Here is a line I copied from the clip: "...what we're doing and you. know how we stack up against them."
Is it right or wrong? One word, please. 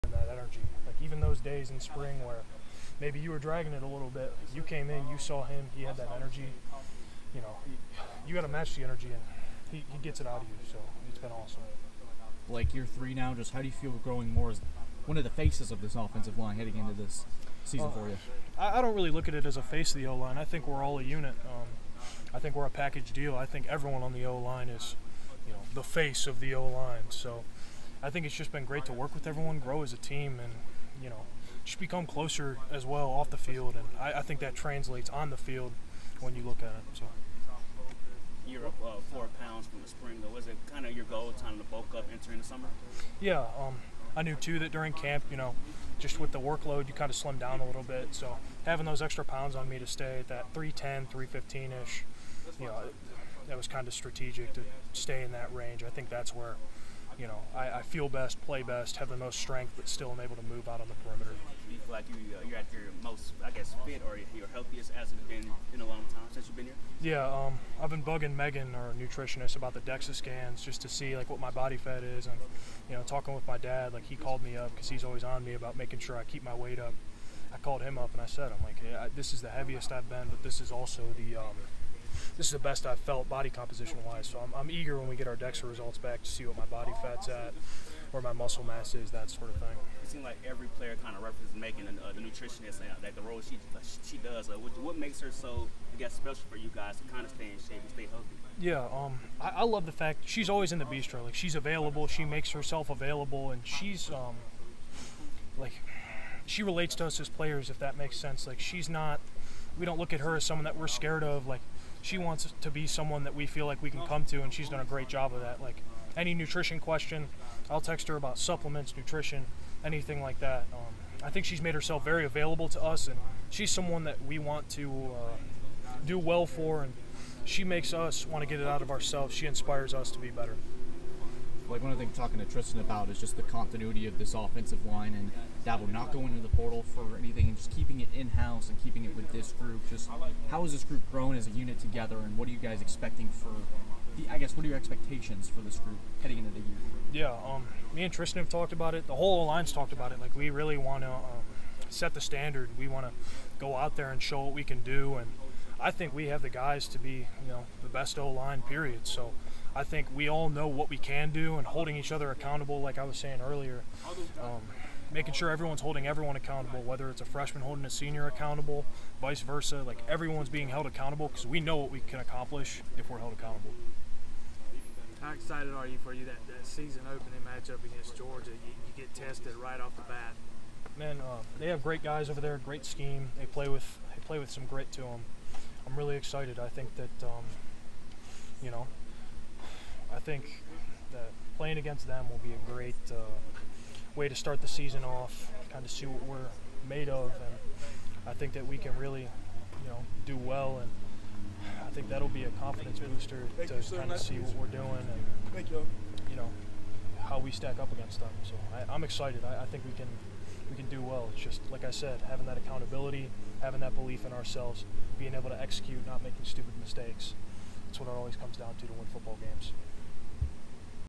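right.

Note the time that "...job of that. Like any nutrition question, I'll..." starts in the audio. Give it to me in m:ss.
1:55.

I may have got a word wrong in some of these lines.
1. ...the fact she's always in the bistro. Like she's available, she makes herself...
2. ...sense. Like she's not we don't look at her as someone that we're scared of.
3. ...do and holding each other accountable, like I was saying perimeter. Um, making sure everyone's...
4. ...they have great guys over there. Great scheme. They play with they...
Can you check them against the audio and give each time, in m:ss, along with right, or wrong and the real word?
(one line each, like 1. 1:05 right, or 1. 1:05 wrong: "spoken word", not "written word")
1. 1:39 right
2. 1:48 right
3. 2:41 wrong: "earlier", not "perimeter"
4. 3:01 right.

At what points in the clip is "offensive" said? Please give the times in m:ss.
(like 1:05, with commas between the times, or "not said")
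0:15, 2:14.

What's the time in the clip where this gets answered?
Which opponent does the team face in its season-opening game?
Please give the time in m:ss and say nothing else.
2:58.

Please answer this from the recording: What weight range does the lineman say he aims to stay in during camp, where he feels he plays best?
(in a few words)
310 to 315.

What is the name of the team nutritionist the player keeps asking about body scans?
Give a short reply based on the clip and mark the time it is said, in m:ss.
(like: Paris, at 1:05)
Megan, at 1:08.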